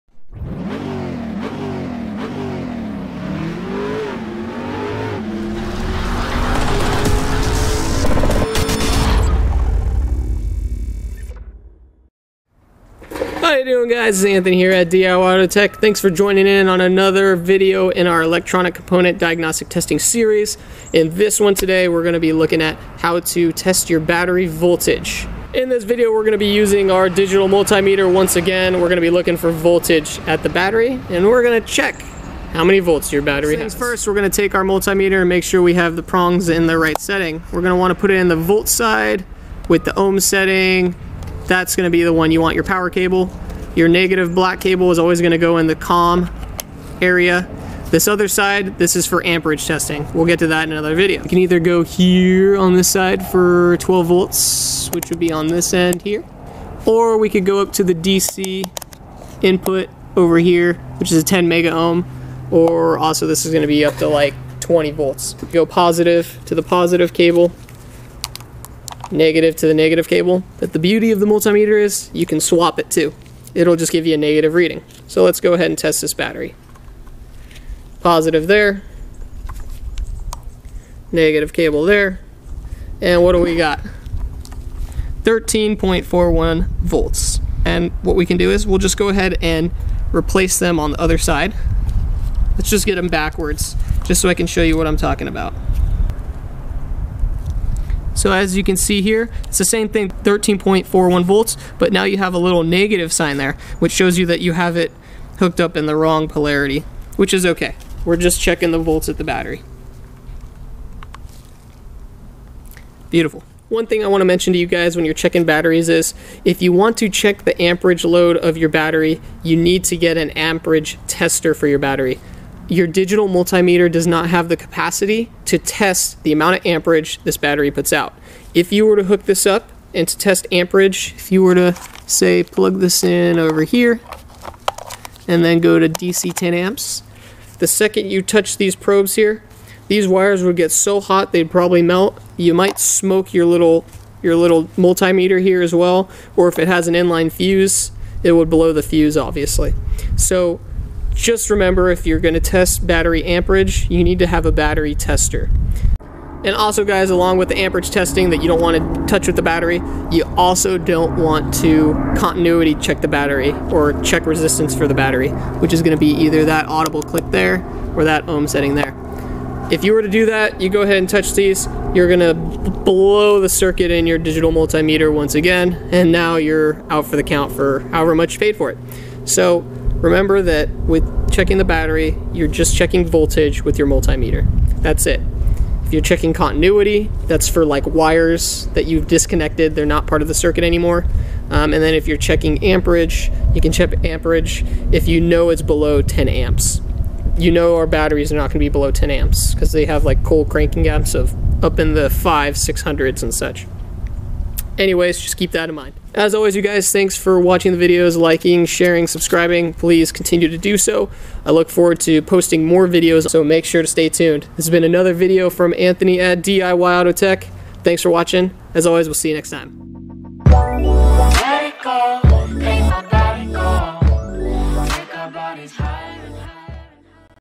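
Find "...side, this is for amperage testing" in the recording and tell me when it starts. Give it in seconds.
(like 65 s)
48 s.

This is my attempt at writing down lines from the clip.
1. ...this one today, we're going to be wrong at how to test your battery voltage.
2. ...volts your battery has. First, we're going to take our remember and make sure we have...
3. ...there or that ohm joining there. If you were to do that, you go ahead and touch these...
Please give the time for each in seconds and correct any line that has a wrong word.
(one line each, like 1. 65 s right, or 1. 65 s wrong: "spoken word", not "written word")
1. 21 s wrong: "looking", not "wrong"
2. 32 s wrong: "multimeter", not "remember"
3. 167 s wrong: "setting", not "joining".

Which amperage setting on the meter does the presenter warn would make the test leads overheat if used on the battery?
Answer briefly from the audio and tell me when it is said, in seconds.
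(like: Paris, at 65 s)
DC 10 amps, at 135 s.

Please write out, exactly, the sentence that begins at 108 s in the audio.
We're just checking the volts at the battery.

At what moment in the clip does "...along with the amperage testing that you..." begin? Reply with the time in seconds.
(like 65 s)
157 s.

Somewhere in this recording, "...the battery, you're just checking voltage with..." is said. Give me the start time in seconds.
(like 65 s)
181 s.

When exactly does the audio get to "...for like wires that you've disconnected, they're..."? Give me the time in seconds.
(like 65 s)
187 s.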